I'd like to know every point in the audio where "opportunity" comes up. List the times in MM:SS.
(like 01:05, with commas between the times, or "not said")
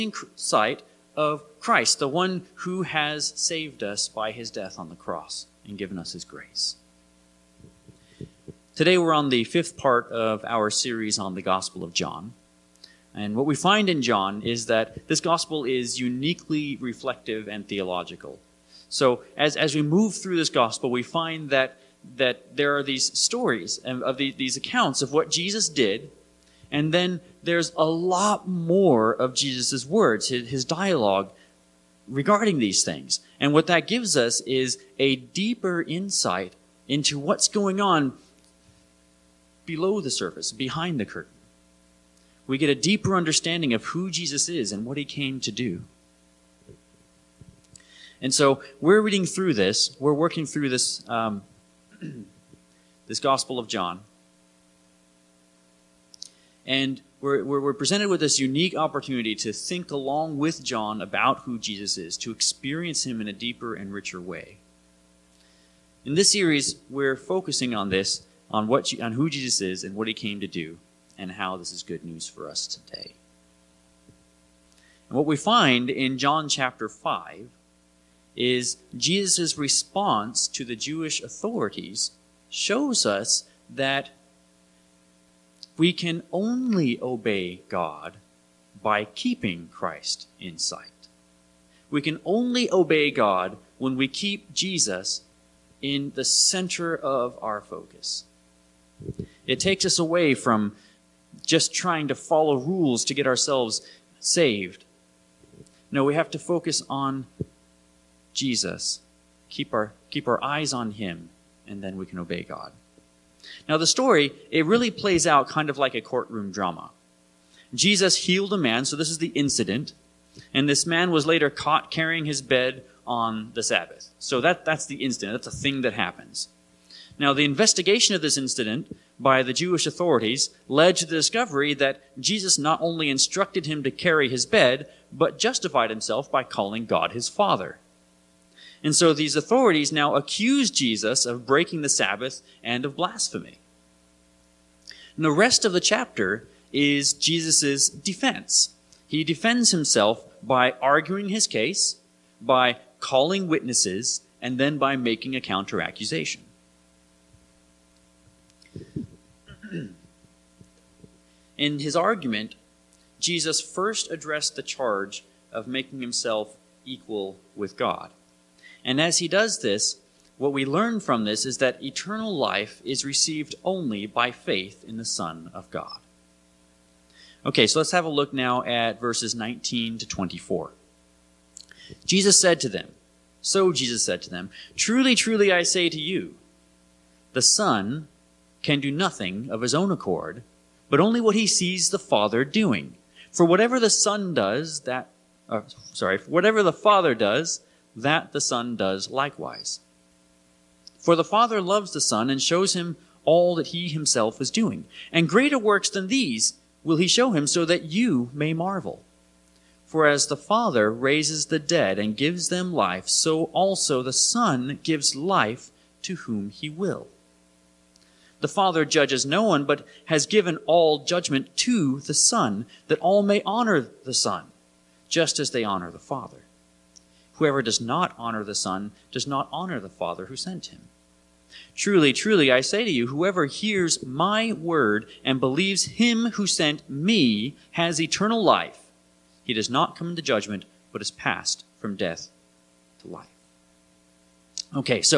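00:58.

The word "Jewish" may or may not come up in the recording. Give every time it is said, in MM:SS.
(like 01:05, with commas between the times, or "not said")
01:20, 02:09.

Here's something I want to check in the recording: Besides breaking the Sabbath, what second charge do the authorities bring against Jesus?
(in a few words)
Blasphemy.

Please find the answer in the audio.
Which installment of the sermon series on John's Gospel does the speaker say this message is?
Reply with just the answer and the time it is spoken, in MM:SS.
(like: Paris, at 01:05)
Fifth part, at 00:09.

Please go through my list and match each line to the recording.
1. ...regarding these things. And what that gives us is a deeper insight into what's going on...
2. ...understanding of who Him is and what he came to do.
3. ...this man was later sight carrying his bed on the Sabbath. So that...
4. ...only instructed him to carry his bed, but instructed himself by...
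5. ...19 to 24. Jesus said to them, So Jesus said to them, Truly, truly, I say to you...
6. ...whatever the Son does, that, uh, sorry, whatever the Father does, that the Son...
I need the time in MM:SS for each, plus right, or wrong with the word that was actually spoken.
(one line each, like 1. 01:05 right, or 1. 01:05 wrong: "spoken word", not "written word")
1. 00:32 right
2. 00:43 wrong: "Jesus", not "Him"
3. 02:00 wrong: "caught", not "sight"
4. 02:12 wrong: "justified", not "instructed"
5. 02:59 right
6. 03:13 right.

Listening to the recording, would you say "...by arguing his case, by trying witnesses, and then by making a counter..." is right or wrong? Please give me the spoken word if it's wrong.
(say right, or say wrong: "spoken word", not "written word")
wrong: "calling", not "trying".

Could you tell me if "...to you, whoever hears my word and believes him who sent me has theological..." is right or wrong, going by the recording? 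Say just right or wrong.
wrong.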